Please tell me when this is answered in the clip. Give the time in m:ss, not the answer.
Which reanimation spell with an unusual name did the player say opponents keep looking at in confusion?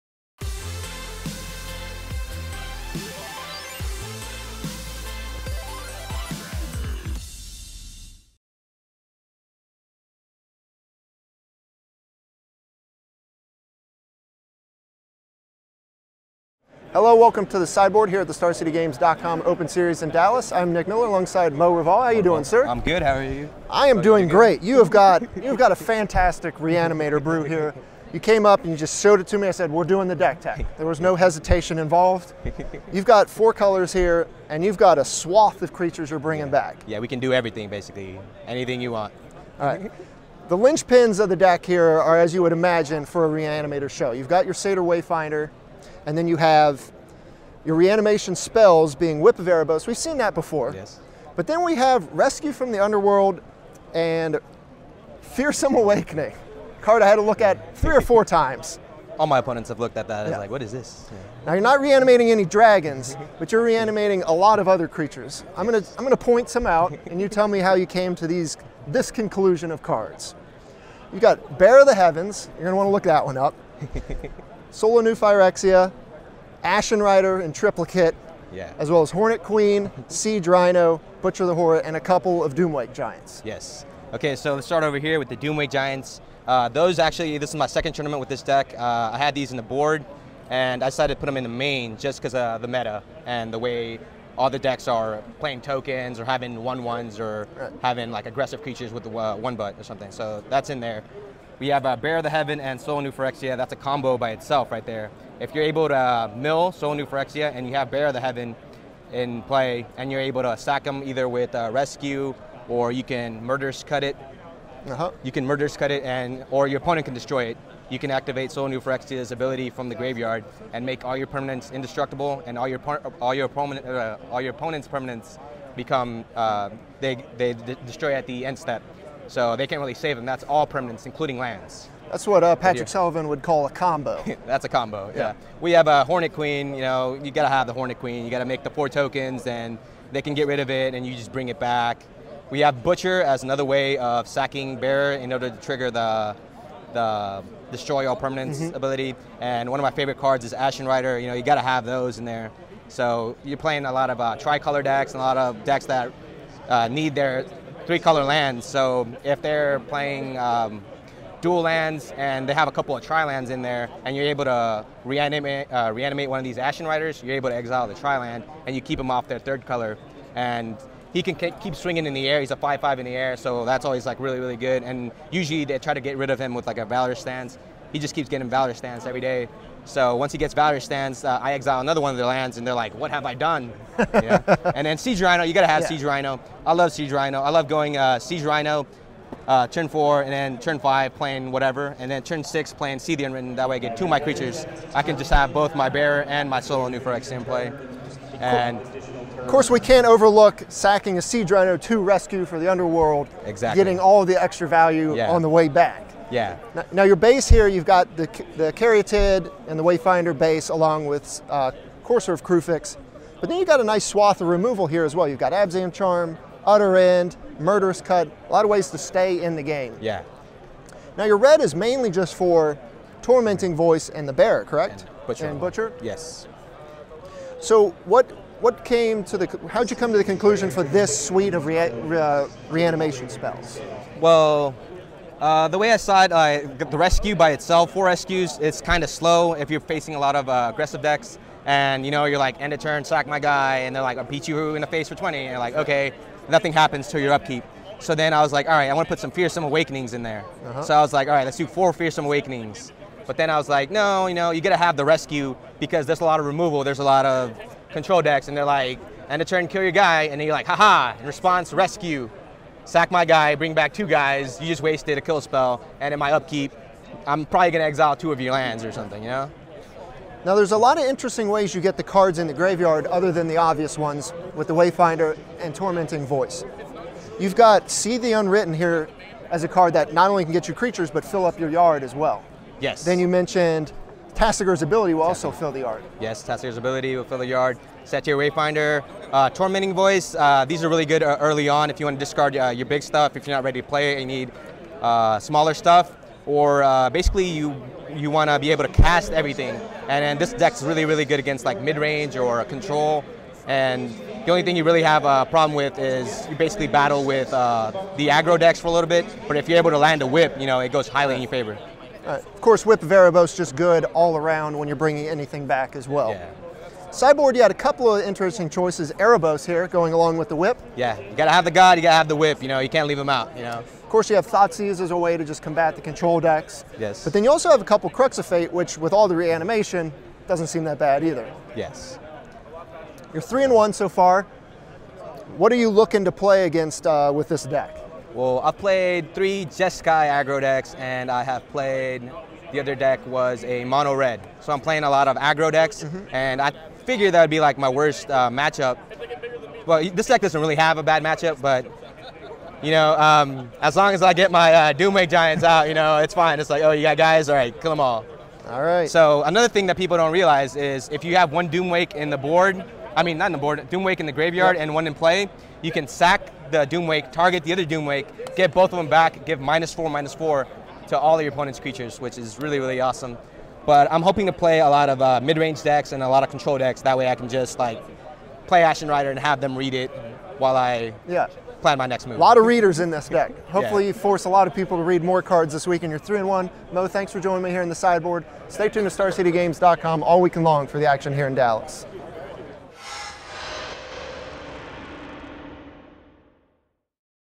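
0:55.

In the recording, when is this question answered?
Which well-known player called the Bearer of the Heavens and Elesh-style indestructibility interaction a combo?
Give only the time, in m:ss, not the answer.
2:12.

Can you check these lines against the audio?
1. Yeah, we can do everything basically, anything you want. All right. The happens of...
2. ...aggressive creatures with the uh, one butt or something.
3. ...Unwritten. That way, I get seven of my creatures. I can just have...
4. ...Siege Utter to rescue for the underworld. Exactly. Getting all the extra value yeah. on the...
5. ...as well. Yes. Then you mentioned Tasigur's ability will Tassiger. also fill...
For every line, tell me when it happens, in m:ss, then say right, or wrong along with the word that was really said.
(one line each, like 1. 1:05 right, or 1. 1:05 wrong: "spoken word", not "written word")
1. 0:36 wrong: "linchpins", not "happens"
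2. 1:38 right
3. 3:13 wrong: "two", not "seven"
4. 3:21 wrong: "Rhino", not "Utter"
5. 4:42 right.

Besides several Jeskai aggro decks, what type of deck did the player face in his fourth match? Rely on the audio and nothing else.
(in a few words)
mono red.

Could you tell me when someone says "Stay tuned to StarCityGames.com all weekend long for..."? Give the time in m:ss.
6:28.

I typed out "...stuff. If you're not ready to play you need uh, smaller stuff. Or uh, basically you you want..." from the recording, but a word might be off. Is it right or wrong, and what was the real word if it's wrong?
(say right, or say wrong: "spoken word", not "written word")
right.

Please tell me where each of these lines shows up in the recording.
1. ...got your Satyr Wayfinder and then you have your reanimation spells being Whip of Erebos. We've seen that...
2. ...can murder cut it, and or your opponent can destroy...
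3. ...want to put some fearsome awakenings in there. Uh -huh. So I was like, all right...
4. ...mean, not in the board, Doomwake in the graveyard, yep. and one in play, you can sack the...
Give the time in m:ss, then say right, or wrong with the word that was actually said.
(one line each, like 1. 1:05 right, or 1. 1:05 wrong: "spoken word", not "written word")
1. 0:44 right
2. 1:55 right
3. 4:08 right
4. 6:03 right.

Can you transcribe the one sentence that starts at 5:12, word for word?
Uh, of course, Whip of Erebos just good all around when you're bringing anything back as well.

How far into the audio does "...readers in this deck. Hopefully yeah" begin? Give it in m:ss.
6:22.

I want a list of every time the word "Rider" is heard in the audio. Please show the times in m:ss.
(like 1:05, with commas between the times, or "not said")
1:17, 2:30, 2:46, 6:19.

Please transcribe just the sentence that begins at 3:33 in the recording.
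But then you've got a nice swath of removal here as well.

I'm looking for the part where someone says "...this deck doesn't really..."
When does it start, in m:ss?
5:50.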